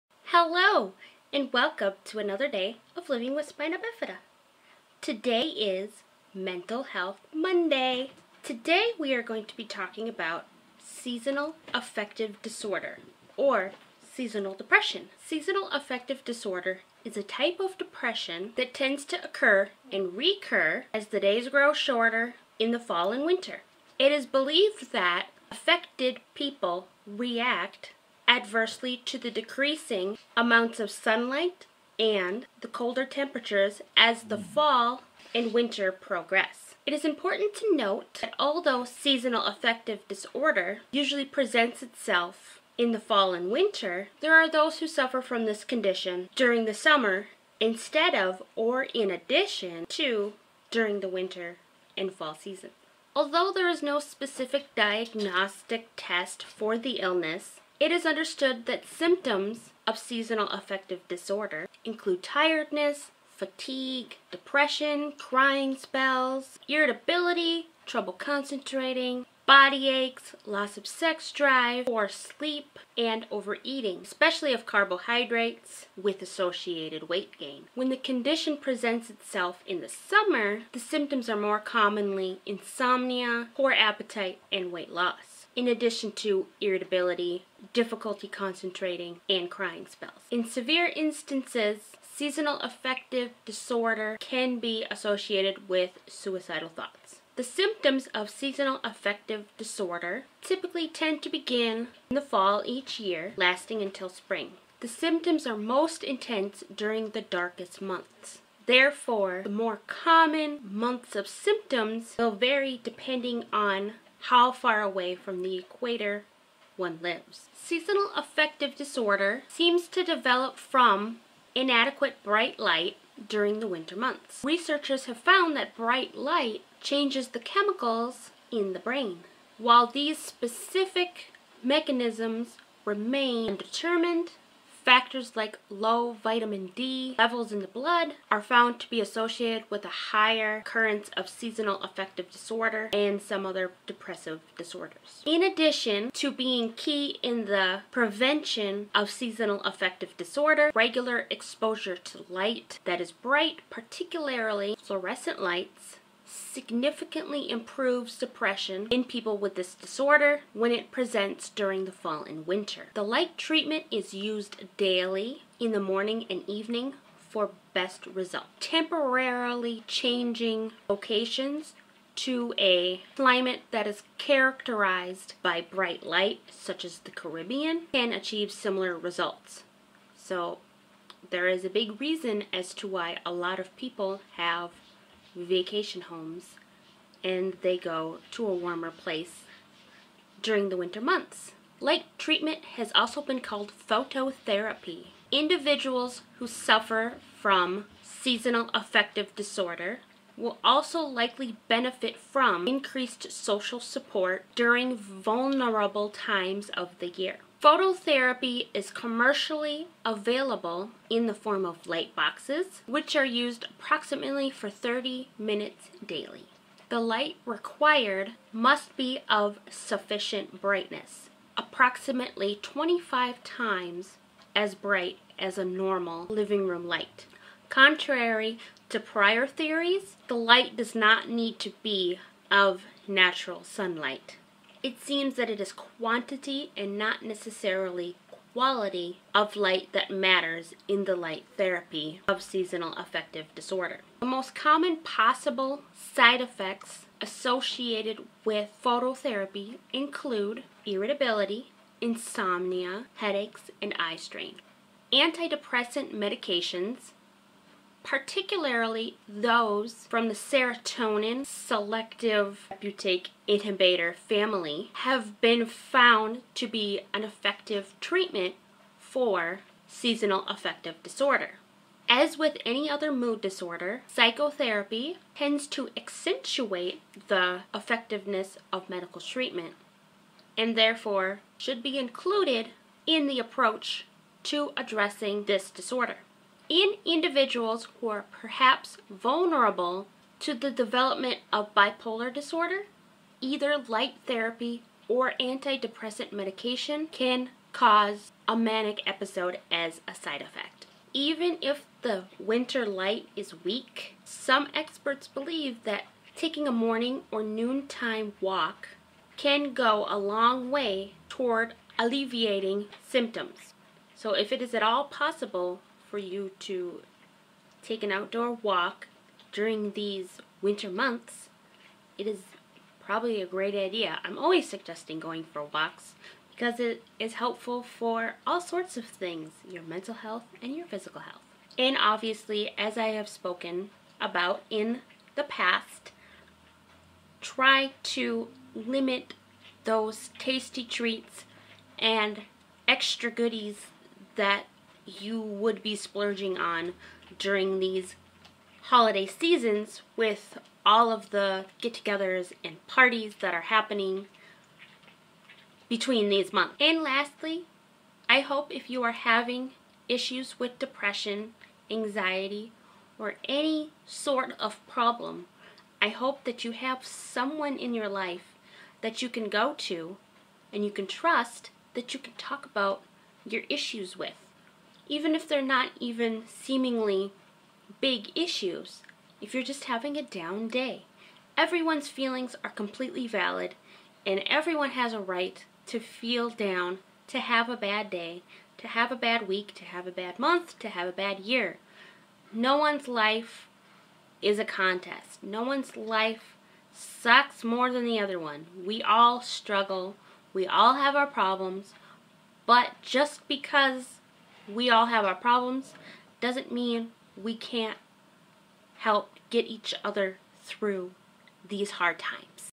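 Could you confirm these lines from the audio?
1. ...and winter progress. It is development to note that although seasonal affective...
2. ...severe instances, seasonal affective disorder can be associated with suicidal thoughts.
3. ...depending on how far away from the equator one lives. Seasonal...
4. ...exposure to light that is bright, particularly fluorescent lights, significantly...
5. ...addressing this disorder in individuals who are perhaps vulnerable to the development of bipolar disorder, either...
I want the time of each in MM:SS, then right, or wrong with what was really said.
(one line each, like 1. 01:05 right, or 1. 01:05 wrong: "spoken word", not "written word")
1. 00:35 wrong: "important", not "development"
2. 01:30 right
3. 01:52 right
4. 02:31 right
5. 04:44 right.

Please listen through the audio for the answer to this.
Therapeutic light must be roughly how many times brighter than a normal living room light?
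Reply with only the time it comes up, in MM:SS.
03:42.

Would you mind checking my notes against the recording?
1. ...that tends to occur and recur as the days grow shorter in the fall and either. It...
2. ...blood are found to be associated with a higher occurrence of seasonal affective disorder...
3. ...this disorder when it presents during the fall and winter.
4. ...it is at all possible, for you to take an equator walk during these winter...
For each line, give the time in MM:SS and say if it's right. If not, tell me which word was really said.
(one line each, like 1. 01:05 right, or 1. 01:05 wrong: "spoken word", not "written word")
1. 00:18 wrong: "winter", not "either"
2. 02:17 right
3. 02:39 right
4. 05:14 wrong: "outdoor", not "equator".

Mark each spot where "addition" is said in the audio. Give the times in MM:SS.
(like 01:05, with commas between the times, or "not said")
00:49, 01:25, 02:25.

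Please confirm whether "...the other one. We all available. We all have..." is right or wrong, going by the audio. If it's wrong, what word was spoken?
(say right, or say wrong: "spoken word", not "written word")
wrong: "struggle", not "available".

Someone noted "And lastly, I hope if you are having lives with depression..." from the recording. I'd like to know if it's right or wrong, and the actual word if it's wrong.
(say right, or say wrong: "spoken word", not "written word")
wrong: "issues", not "lives".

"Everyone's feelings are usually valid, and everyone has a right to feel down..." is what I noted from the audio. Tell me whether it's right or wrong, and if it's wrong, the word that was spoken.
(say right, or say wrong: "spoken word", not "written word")
wrong: "completely", not "usually".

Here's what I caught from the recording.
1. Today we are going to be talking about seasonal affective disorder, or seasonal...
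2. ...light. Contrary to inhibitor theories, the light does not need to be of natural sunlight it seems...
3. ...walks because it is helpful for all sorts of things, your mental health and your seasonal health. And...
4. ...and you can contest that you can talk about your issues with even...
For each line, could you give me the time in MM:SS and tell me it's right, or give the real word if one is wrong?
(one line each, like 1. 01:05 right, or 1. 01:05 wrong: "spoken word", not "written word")
1. 00:08 right
2. 03:46 wrong: "prior", not "inhibitor"
3. 05:25 wrong: "physical", not "seasonal"
4. 06:10 wrong: "trust", not "contest".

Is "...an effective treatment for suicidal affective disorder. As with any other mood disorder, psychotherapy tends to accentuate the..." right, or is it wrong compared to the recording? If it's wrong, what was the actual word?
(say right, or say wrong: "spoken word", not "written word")
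wrong: "seasonal", not "suicidal".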